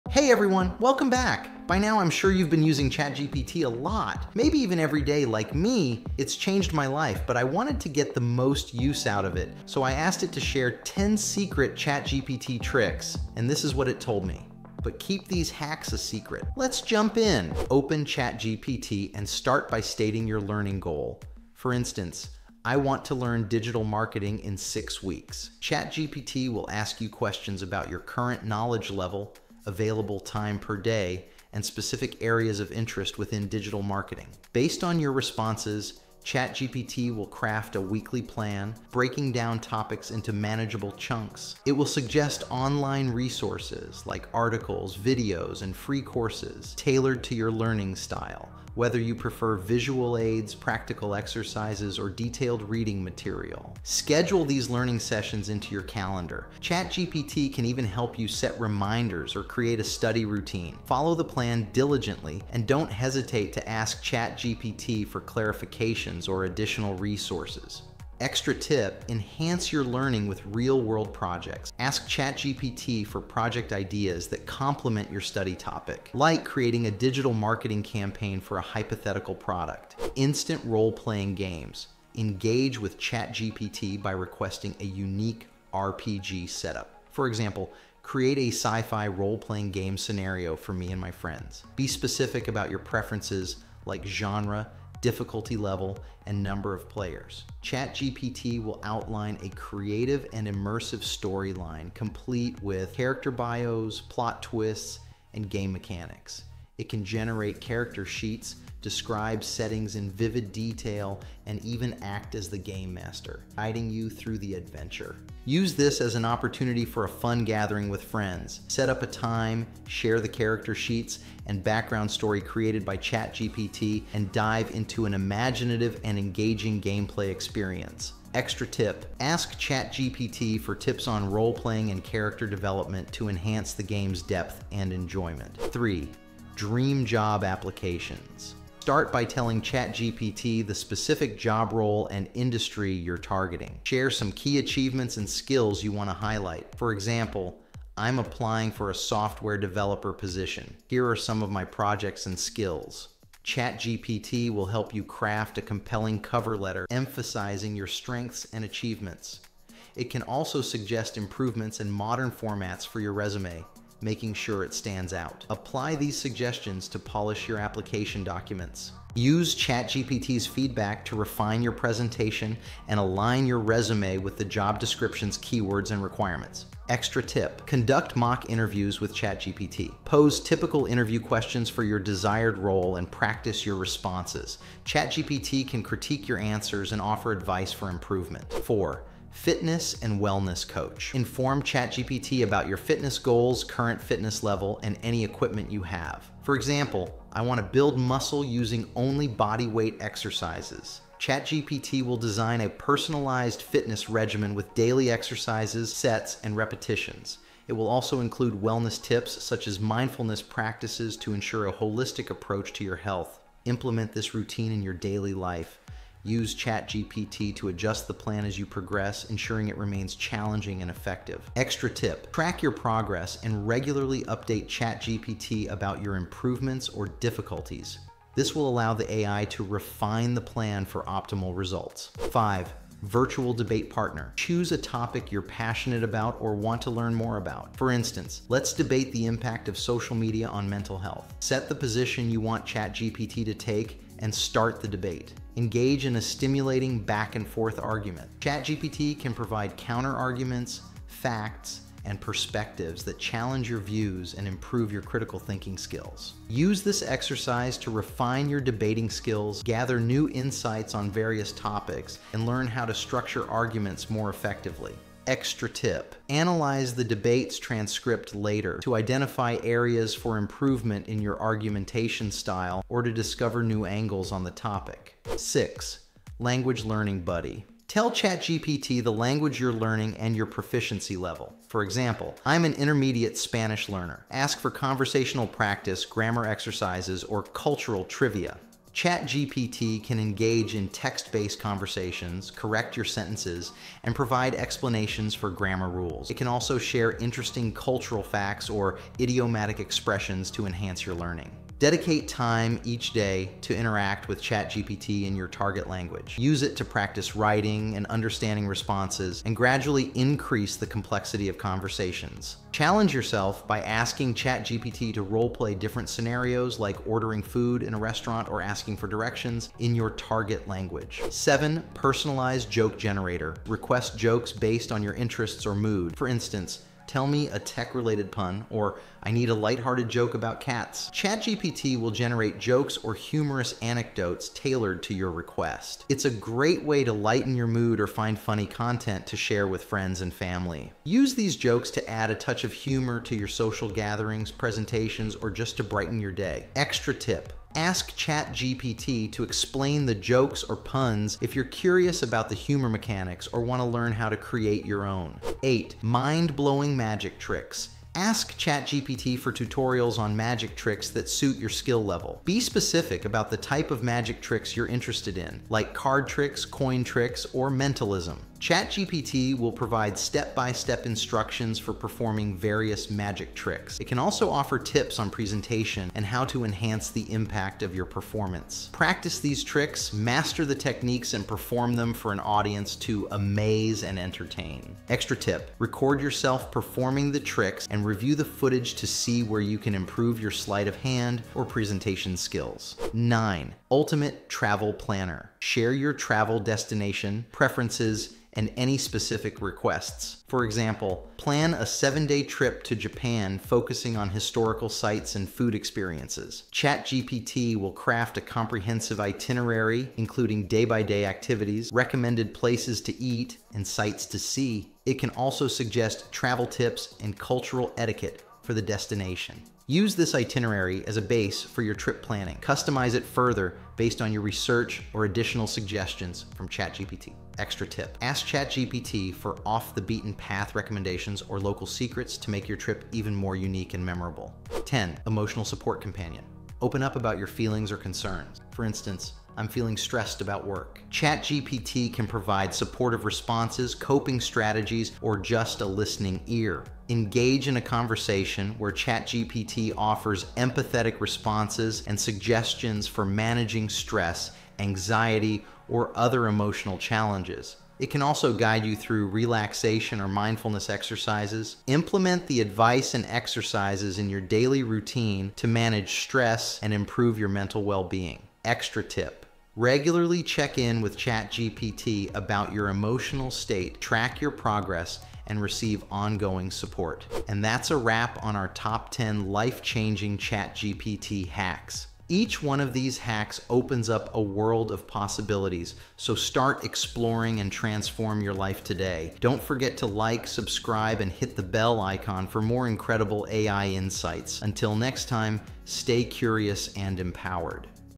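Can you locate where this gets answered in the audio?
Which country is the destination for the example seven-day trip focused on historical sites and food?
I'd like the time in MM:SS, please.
06:42.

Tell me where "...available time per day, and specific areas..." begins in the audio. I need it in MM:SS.
00:29.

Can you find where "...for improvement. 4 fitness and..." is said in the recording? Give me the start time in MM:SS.
03:07.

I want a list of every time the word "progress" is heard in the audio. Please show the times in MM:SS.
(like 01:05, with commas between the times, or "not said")
03:38, 03:42, 07:54.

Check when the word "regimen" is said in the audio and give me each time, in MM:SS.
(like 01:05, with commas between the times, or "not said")
03:24.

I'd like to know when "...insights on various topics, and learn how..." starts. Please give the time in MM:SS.
04:20.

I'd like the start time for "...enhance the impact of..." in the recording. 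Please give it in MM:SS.
06:16.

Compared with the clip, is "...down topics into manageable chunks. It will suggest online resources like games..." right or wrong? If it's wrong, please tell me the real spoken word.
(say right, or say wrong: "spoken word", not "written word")
wrong: "articles", not "games".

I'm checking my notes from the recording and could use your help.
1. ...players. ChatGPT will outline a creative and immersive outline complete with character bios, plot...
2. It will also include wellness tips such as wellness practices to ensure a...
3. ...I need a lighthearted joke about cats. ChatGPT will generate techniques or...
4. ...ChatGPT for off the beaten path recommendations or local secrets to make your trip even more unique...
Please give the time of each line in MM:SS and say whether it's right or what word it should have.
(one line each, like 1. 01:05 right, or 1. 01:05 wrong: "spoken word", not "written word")
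1. 01:36 wrong: "storyline", not "outline"
2. 03:27 wrong: "mindfulness", not "wellness"
3. 05:29 wrong: "jokes", not "techniques"
4. 07:08 right.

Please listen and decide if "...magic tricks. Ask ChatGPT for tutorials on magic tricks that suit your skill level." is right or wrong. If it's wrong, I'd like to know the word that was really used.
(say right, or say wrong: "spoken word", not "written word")
right.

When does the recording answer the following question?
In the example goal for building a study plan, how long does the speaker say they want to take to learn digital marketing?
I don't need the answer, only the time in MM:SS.
00:24.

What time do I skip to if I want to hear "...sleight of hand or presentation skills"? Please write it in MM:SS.
06:30.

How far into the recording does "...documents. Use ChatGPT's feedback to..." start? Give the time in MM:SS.
02:48.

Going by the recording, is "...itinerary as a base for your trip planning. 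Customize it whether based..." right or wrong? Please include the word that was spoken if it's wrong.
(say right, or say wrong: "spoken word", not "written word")
wrong: "further", not "whether".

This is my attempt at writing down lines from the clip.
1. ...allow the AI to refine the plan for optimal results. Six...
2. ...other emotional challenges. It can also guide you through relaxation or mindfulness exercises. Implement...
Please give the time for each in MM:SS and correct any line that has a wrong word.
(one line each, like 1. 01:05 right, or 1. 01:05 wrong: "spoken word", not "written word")
1. 03:48 wrong: "Five", not "Six"
2. 07:36 right.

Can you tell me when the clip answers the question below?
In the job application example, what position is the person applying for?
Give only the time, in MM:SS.
02:28.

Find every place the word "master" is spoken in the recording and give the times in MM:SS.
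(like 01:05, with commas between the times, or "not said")
01:52, 06:20.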